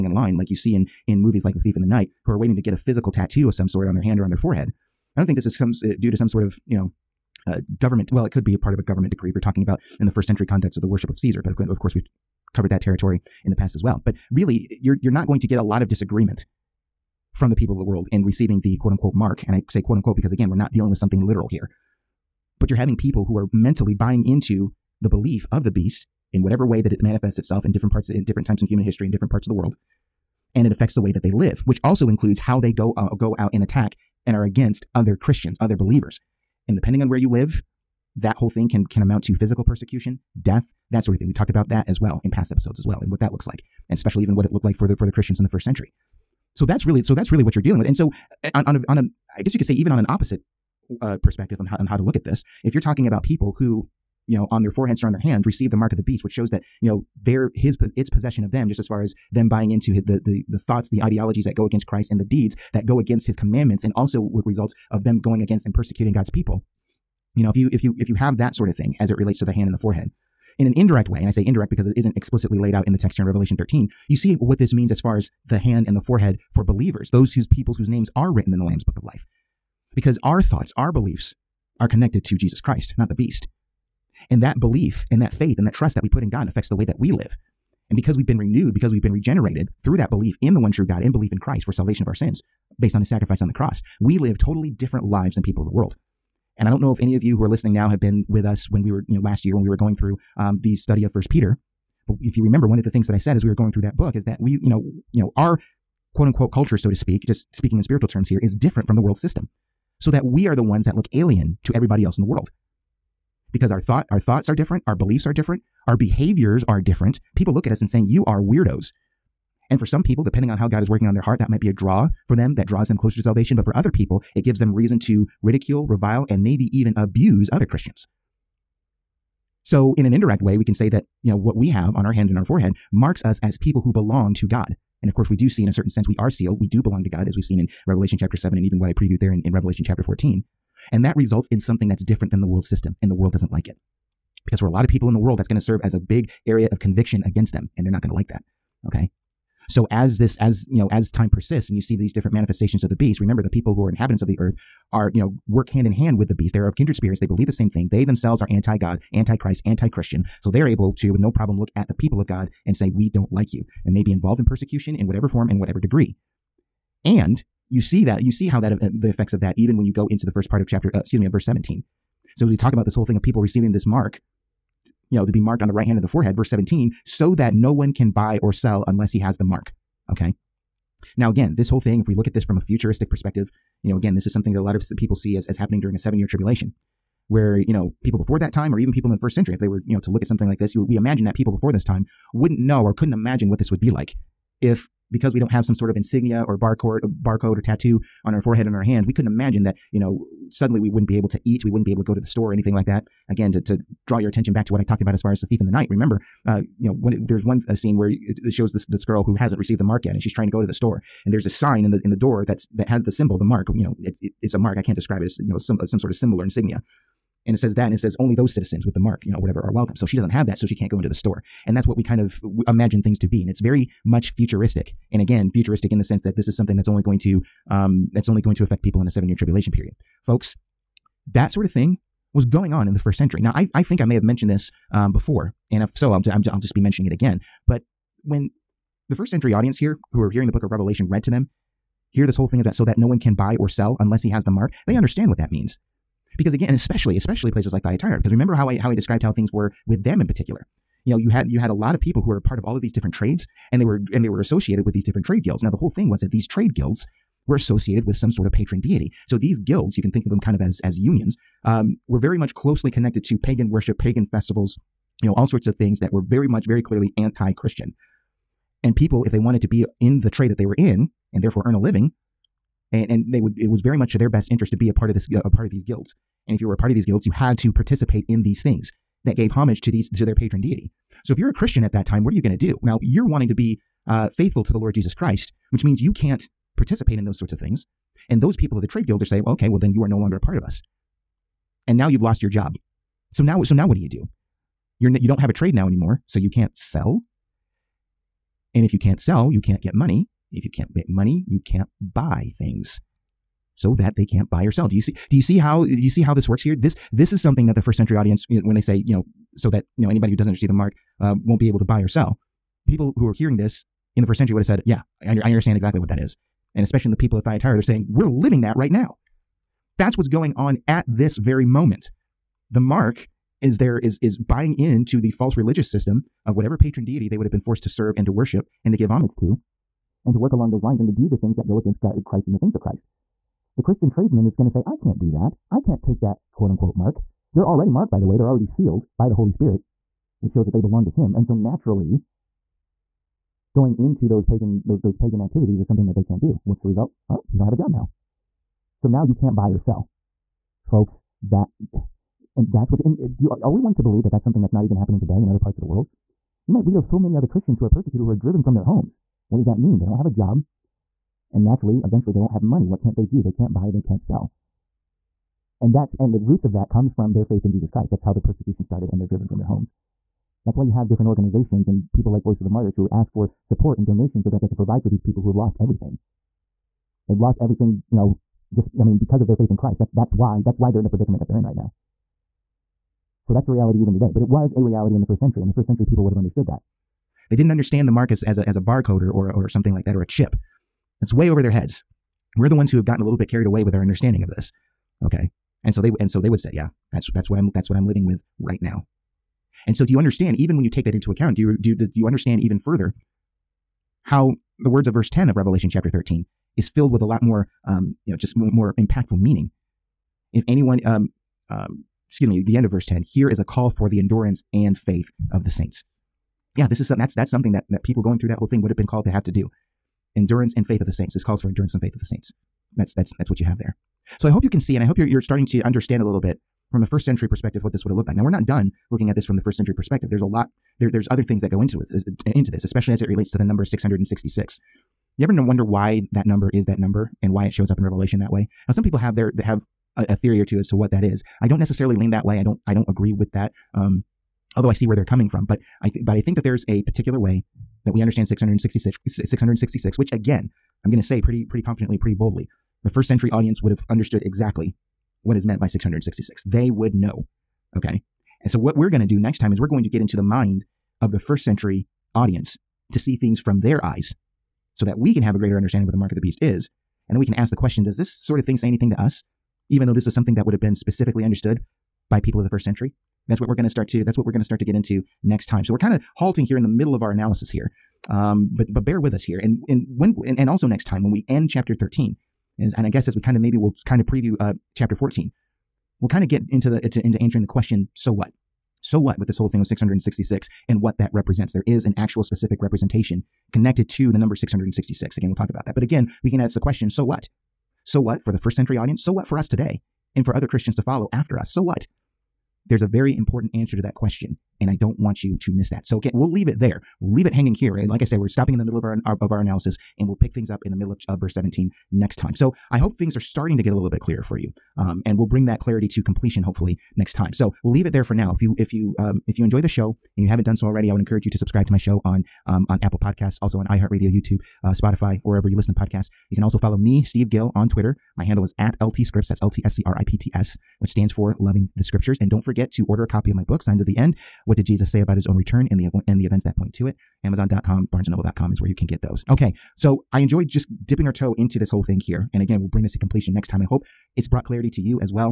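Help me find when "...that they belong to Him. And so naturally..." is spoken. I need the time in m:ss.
5:40.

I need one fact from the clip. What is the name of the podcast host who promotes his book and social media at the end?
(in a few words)
Steve Gill.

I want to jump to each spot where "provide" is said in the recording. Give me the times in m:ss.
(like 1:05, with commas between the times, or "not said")
6:14.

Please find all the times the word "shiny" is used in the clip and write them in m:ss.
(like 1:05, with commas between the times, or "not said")
not said.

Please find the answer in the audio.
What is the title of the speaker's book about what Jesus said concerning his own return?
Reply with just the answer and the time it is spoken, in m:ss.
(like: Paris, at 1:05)
Signs of the End, at 8:53.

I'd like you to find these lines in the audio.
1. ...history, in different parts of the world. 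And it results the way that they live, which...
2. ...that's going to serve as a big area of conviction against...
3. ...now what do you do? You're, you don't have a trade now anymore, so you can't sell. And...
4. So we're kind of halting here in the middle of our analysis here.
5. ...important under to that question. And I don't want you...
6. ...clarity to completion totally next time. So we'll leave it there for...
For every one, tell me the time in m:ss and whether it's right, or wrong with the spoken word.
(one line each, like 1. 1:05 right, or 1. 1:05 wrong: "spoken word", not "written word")
1. 0:28 wrong: "affects", not "results"
2. 2:25 right
3. 4:53 right
4. 7:55 right
5. 8:23 wrong: "answer", not "under"
6. 8:35 wrong: "hopefully", not "totally".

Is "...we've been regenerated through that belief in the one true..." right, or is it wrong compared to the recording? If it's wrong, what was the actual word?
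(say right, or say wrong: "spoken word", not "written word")
right.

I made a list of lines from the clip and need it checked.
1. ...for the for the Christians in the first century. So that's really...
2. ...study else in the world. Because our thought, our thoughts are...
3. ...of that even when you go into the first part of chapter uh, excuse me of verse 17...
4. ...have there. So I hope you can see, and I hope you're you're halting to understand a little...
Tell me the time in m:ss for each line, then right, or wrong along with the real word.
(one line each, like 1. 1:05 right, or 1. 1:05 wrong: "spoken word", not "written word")
1. 0:44 right
2. 1:51 wrong: "everybody", not "study"
3. 2:49 right
4. 7:03 wrong: "starting", not "halting".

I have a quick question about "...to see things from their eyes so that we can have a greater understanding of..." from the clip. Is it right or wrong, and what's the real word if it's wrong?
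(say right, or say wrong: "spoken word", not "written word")
right.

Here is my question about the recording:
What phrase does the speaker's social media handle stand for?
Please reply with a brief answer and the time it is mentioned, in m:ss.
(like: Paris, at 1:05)
Loving the Scriptures, at 8:51.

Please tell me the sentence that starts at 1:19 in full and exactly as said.
Because our thoughts, our beliefs are connected to Jesus Christ, not the beast.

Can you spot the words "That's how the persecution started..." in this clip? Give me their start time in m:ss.
6:08.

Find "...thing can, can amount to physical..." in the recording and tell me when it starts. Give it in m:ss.
0:38.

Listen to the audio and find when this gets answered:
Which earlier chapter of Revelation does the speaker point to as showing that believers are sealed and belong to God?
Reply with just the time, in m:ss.
2:17.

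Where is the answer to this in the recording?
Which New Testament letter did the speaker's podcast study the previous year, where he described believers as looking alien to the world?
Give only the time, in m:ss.
1:41.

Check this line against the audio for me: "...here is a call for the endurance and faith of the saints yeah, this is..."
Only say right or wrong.
right.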